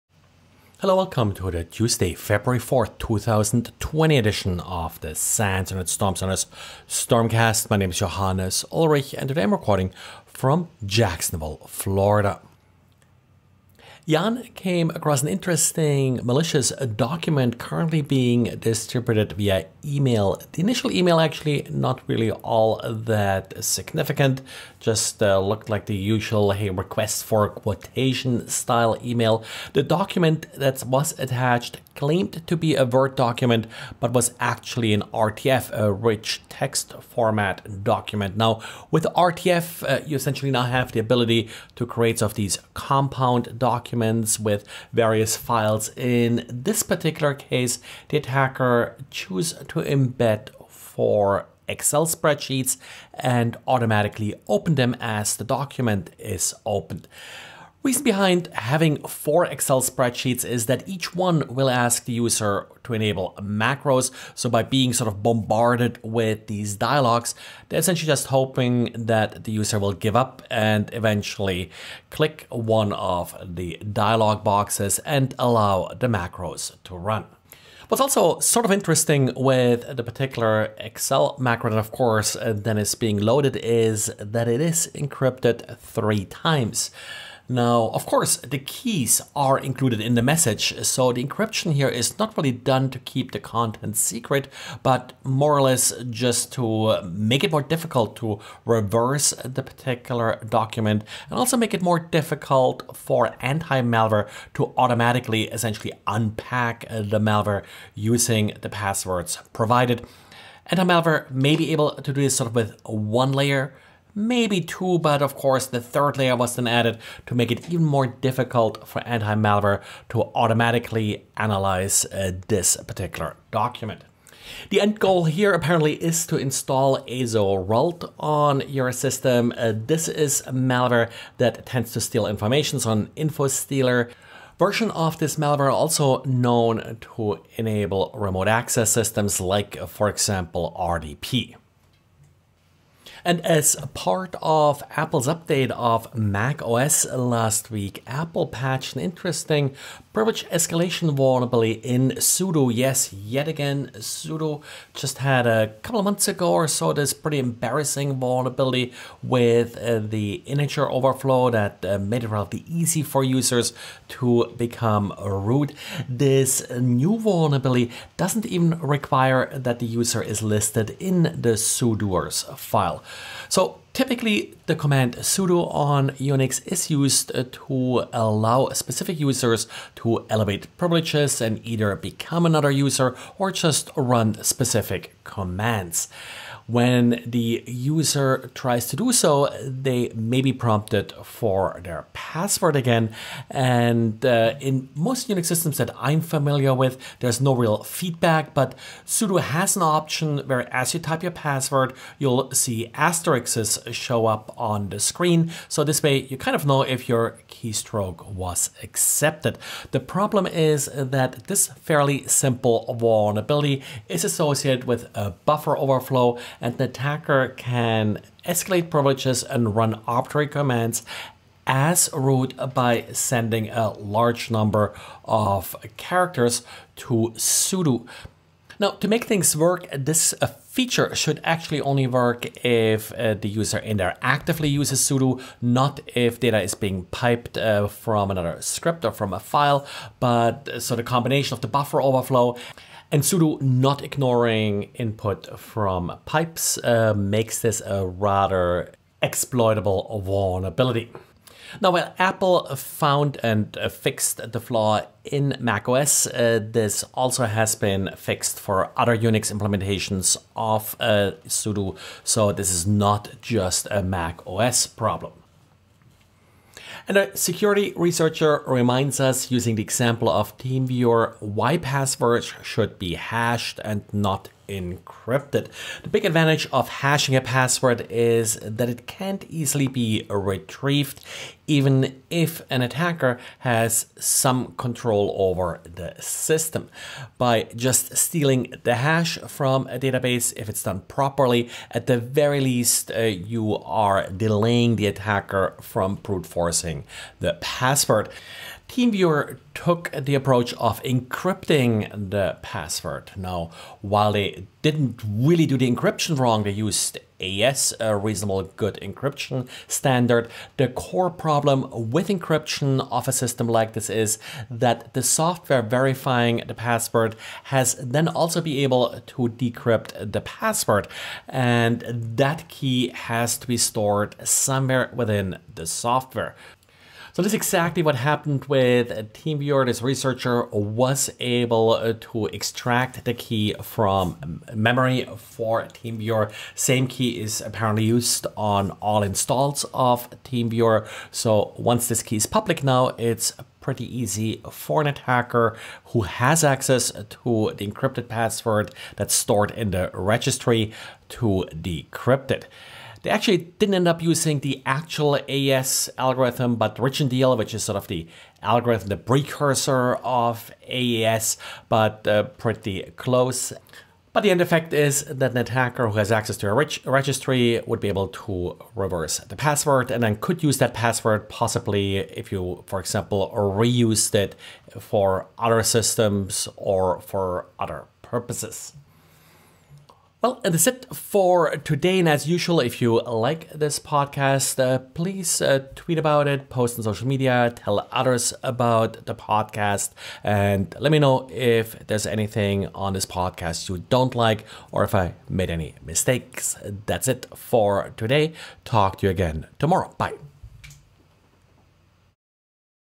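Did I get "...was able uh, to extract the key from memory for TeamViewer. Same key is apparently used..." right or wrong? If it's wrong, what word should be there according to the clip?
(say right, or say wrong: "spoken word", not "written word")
right.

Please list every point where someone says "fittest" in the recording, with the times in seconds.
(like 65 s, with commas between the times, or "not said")
not said.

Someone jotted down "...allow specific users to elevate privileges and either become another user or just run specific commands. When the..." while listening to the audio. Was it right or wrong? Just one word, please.
right.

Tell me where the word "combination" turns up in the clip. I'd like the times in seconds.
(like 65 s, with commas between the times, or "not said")
241 s.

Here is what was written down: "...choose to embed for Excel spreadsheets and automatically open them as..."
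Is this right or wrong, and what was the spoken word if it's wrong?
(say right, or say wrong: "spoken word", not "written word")
right.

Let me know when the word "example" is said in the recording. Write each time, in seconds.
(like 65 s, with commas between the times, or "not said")
140 s, 269 s, 373 s.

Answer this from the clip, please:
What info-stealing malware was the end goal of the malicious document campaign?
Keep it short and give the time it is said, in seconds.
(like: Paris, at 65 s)
Azorult, at 127 s.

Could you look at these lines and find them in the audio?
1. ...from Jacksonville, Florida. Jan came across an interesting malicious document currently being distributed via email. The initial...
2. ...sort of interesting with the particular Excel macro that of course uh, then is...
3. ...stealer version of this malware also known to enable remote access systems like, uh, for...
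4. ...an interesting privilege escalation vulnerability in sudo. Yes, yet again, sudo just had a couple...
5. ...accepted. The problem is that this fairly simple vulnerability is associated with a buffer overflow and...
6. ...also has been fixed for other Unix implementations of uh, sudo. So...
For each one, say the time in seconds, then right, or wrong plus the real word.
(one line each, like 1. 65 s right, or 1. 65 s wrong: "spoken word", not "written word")
1. 10 s right
2. 78 s right
3. 133 s right
4. 148 s right
5. 208 s right
6. 257 s right.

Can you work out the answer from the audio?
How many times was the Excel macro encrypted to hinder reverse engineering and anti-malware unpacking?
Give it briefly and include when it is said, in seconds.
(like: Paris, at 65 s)
3, at 85 s.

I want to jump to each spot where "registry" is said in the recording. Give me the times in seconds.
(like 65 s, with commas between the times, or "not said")
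350 s, 367 s.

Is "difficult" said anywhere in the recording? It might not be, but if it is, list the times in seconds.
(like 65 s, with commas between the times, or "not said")
97 s, 101 s, 118 s.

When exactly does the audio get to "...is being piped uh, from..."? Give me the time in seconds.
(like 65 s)
236 s.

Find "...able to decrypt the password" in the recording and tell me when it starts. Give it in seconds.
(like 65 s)
318 s.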